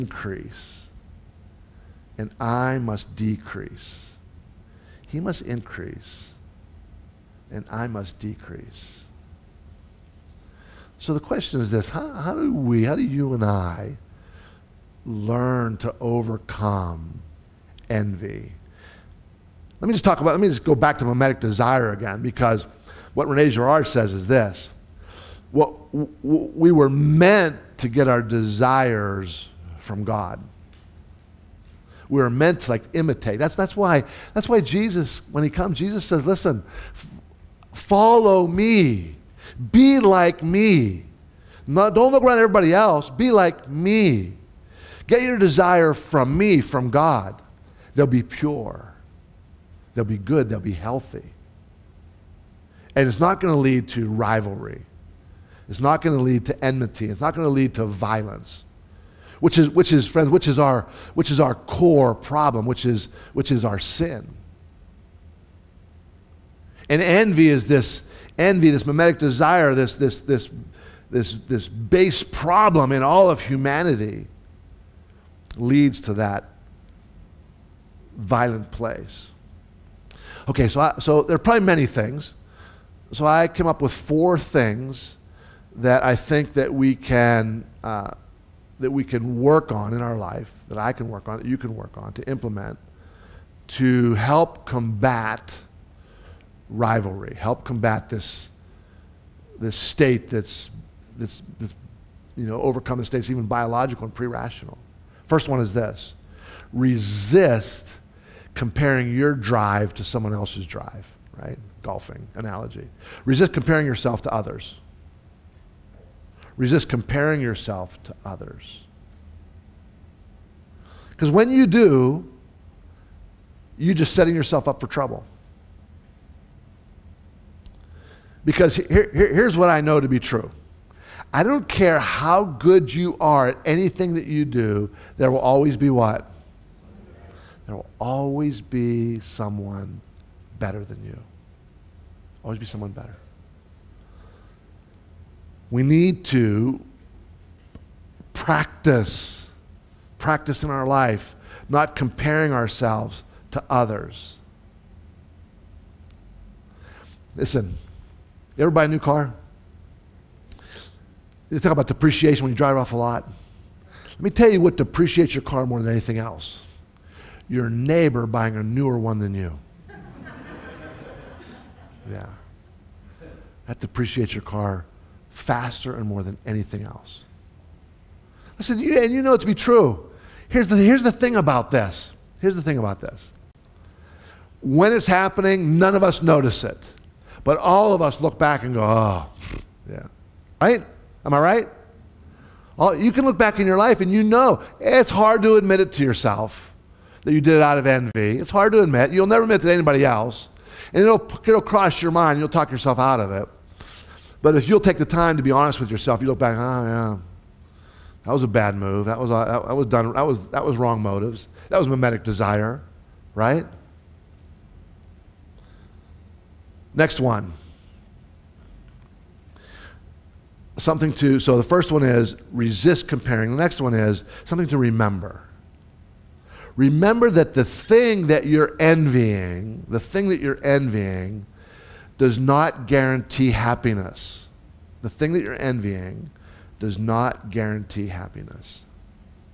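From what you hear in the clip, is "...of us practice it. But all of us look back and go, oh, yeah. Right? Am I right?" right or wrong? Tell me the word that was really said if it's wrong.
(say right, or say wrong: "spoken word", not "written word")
wrong: "notice", not "practice".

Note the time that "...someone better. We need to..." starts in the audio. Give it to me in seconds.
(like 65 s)
142 s.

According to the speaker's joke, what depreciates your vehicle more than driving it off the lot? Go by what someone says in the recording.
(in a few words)
Neighbor buying a newer one.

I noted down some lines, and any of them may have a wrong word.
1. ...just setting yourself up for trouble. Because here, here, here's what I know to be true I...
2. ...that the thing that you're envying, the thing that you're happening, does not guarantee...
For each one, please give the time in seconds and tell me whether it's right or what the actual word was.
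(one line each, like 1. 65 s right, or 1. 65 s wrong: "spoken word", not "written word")
1. 123 s right
2. 227 s wrong: "envying", not "happening".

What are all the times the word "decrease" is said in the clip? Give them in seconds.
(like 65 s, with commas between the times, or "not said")
3 s, 8 s.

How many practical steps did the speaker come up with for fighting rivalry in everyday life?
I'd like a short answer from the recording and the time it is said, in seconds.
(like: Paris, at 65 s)
4, at 83 s.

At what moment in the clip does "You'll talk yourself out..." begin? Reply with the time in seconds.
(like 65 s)
202 s.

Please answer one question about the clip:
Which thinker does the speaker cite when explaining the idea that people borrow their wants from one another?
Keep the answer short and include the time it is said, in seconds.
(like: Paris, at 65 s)
Rene Girard, at 23 s.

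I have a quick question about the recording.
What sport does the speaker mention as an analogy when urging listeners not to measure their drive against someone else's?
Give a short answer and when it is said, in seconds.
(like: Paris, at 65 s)
Golfing, at 111 s.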